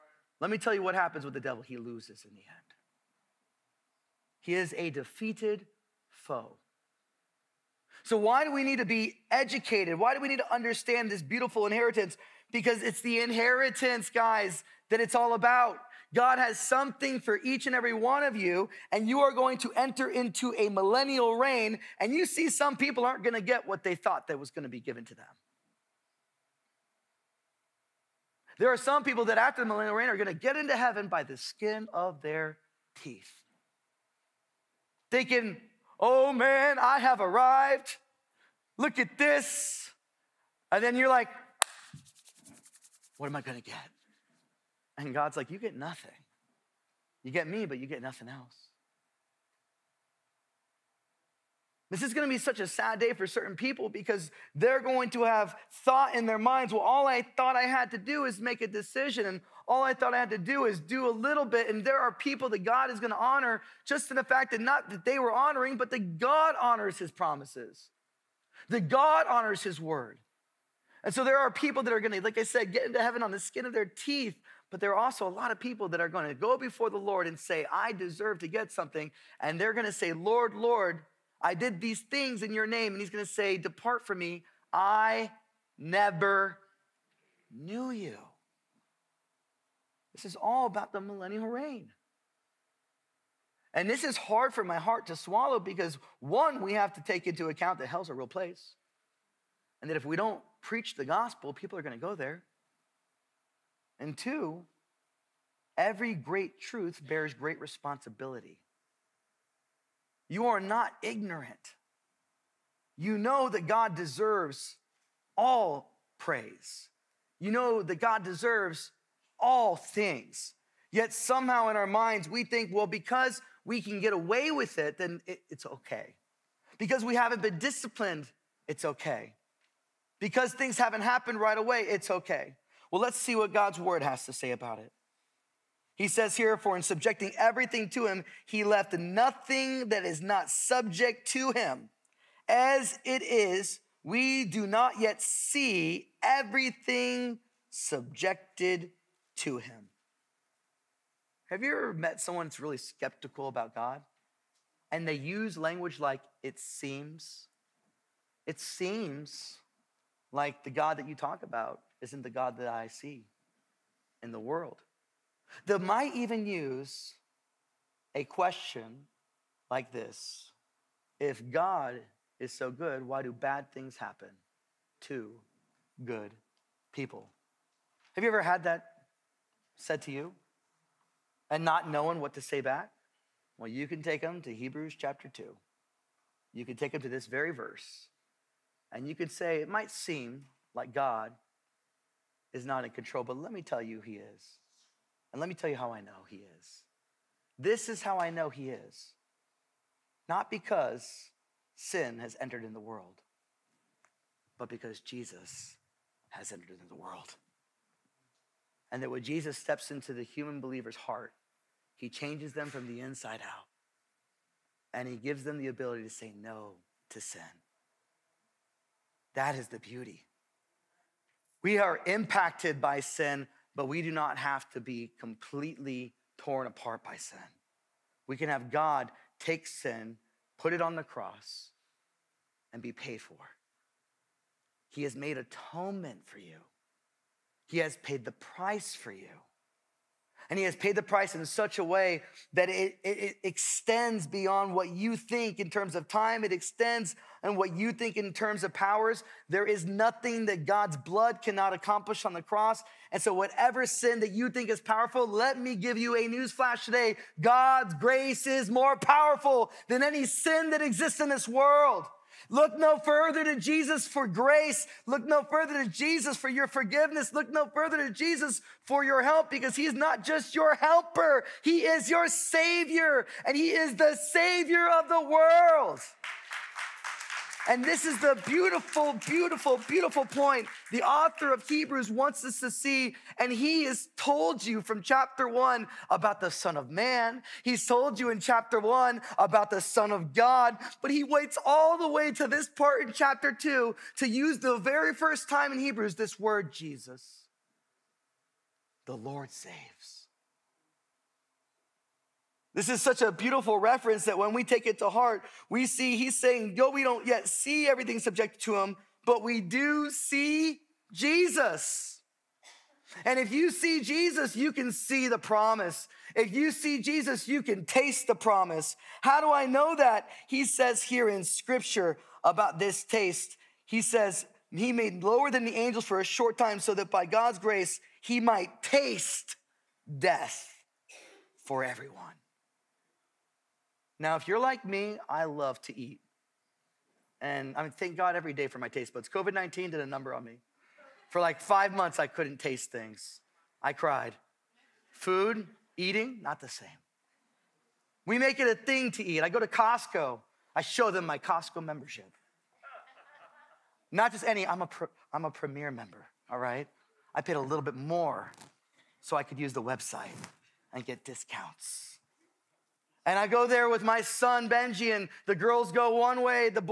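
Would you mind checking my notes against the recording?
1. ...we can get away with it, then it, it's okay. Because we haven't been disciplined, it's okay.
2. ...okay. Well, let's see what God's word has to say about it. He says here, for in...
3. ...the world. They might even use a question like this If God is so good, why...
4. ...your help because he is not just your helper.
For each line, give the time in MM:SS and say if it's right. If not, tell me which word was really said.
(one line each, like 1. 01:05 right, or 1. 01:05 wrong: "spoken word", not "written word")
1. 02:03 right
2. 02:12 right
3. 02:44 right
4. 04:29 right.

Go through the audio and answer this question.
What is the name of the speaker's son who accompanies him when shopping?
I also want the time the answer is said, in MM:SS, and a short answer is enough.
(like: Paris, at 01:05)
Benji, at 06:04.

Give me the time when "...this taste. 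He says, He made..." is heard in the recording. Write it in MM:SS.
05:22.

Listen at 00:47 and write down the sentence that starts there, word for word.
You get me, but you get nothing else.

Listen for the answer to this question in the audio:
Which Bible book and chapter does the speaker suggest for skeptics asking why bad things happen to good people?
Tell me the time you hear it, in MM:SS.
03:04.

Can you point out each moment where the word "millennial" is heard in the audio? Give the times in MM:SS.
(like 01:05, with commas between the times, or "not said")
00:20, 00:29, 01:31.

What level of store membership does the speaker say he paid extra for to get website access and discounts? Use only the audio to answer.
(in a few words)
premier.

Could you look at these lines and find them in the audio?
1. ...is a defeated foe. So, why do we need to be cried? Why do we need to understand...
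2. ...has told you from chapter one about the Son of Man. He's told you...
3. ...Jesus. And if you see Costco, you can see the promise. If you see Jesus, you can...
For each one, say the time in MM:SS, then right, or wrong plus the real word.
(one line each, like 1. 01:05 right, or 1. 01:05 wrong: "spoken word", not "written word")
1. 00:04 wrong: "educated", not "cried"
2. 04:43 right
3. 05:11 wrong: "Jesus", not "Costco".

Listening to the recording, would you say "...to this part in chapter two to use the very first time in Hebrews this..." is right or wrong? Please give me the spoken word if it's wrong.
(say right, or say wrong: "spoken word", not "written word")
right.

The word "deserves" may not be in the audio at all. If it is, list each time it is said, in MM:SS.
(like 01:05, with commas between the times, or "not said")
01:17, 01:53, 01:58.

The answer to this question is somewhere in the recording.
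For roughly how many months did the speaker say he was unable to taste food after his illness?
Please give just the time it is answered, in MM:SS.
05:41.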